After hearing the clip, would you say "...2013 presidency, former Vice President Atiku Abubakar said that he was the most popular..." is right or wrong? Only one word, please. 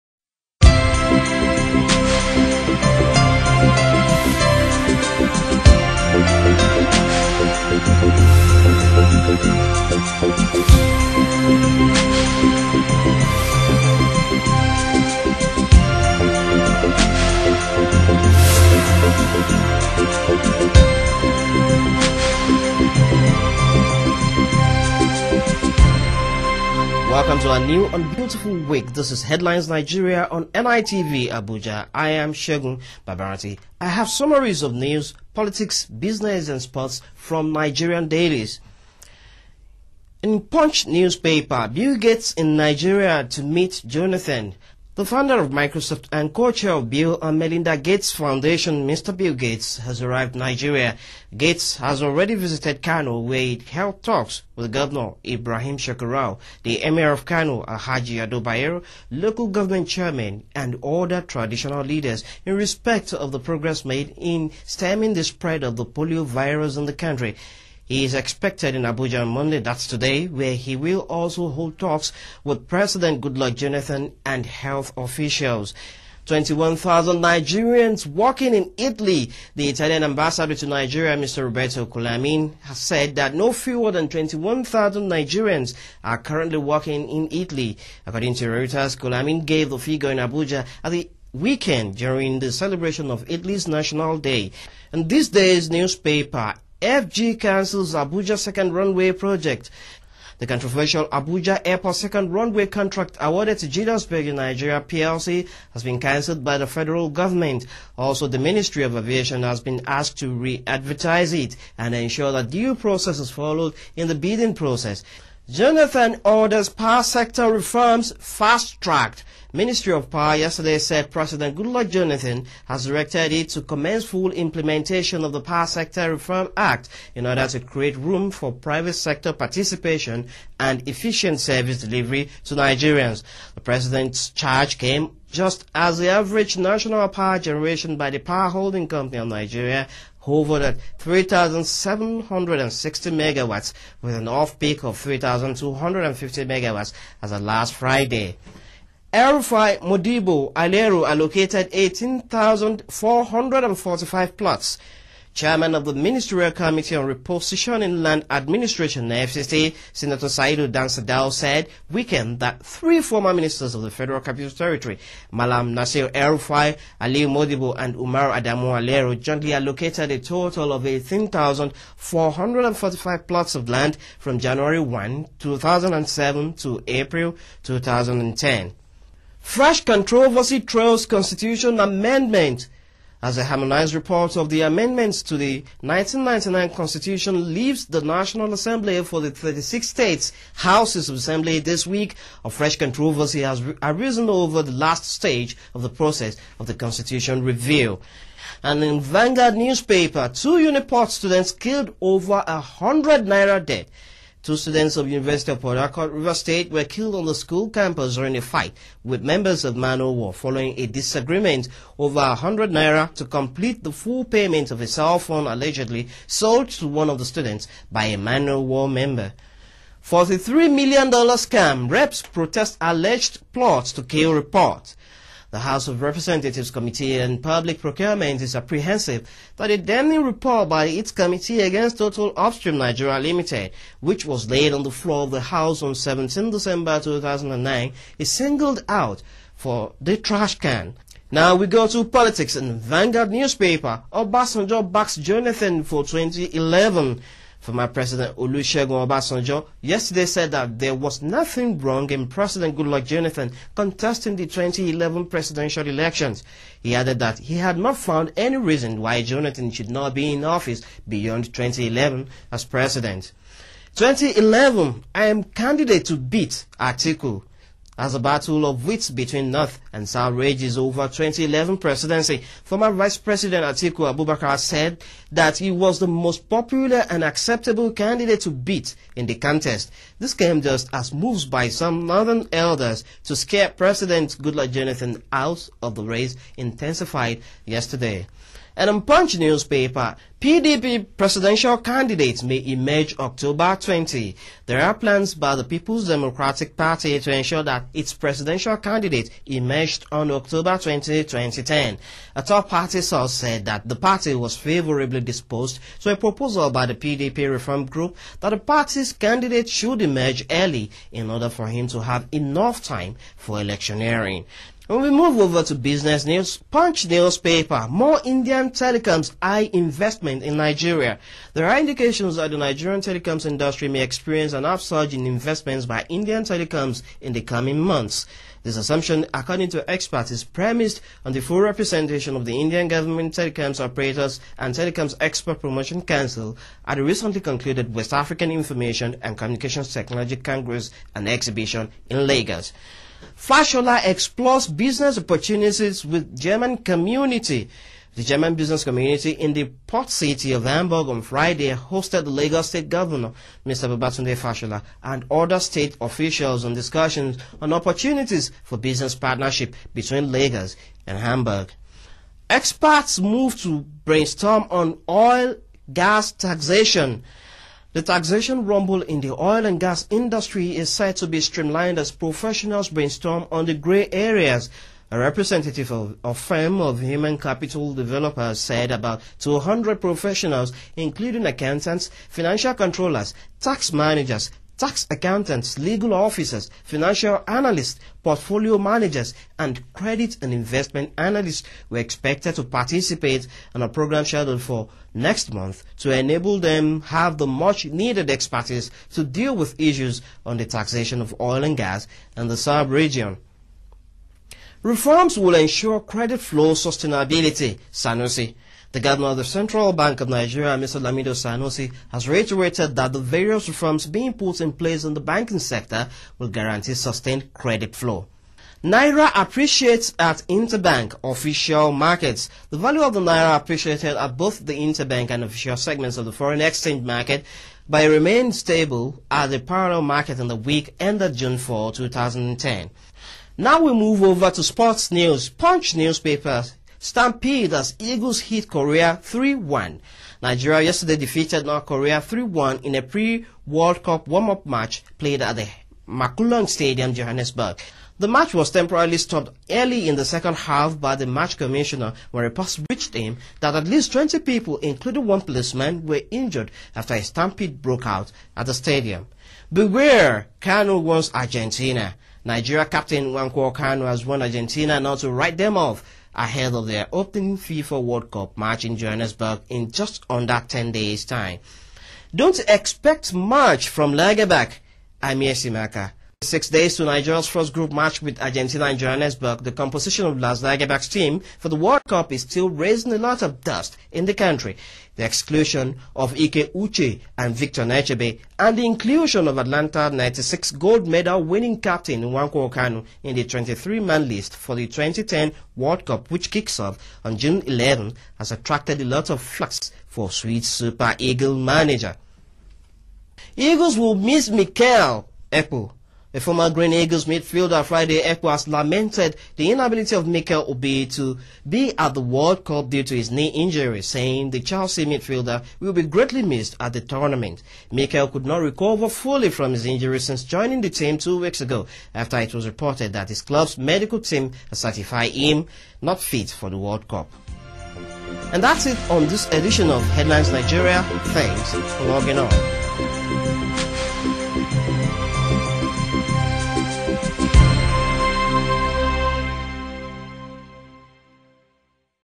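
wrong.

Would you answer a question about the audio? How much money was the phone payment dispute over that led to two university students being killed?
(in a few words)
100 naira.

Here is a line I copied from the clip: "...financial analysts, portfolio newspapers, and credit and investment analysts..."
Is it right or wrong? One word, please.
wrong.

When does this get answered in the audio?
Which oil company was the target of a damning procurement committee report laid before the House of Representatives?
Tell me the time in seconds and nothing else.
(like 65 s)
231 s.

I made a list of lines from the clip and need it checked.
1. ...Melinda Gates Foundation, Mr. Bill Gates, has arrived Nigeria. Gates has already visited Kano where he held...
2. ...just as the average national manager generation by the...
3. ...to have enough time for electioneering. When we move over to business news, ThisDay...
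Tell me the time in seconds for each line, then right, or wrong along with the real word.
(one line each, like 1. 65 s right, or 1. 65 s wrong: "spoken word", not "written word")
1. 47 s right
2. 135 s wrong: "power", not "manager"
3. 311 s wrong: "Punch", not "ThisDay".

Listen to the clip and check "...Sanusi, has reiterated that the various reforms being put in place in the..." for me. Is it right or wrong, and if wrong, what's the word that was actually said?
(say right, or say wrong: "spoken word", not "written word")
right.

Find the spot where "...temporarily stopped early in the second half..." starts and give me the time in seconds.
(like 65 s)
448 s.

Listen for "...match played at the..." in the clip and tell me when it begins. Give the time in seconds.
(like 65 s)
444 s.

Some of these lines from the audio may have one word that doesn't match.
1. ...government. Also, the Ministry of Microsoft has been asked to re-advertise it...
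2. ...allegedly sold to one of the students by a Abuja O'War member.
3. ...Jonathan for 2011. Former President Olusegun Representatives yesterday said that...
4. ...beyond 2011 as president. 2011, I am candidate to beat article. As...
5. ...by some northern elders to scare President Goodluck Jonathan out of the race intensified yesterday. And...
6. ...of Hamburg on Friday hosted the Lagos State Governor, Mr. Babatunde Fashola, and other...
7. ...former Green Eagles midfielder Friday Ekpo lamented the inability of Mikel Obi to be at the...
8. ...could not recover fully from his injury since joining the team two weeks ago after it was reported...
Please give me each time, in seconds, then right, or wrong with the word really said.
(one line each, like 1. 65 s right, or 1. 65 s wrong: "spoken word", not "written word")
1. 107 s wrong: "Aviation", not "Microsoft"
2. 215 s wrong: "Man", not "Abuja"
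3. 245 s wrong: "Obasanjo", not "Representatives"
4. 261 s right
5. 281 s right
6. 350 s right
7. 506 s right
8. 518 s right.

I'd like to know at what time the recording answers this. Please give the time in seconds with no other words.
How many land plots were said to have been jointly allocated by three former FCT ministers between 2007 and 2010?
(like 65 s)
170 s.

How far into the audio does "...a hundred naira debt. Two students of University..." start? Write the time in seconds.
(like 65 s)
202 s.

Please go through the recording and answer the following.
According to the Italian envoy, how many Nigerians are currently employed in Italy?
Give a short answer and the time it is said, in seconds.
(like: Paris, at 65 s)
21,000, at 84 s.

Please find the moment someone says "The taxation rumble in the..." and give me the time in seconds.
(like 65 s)
367 s.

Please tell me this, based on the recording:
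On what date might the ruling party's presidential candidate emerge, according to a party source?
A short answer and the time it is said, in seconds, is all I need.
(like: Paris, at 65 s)
October 20, 2010, at 300 s.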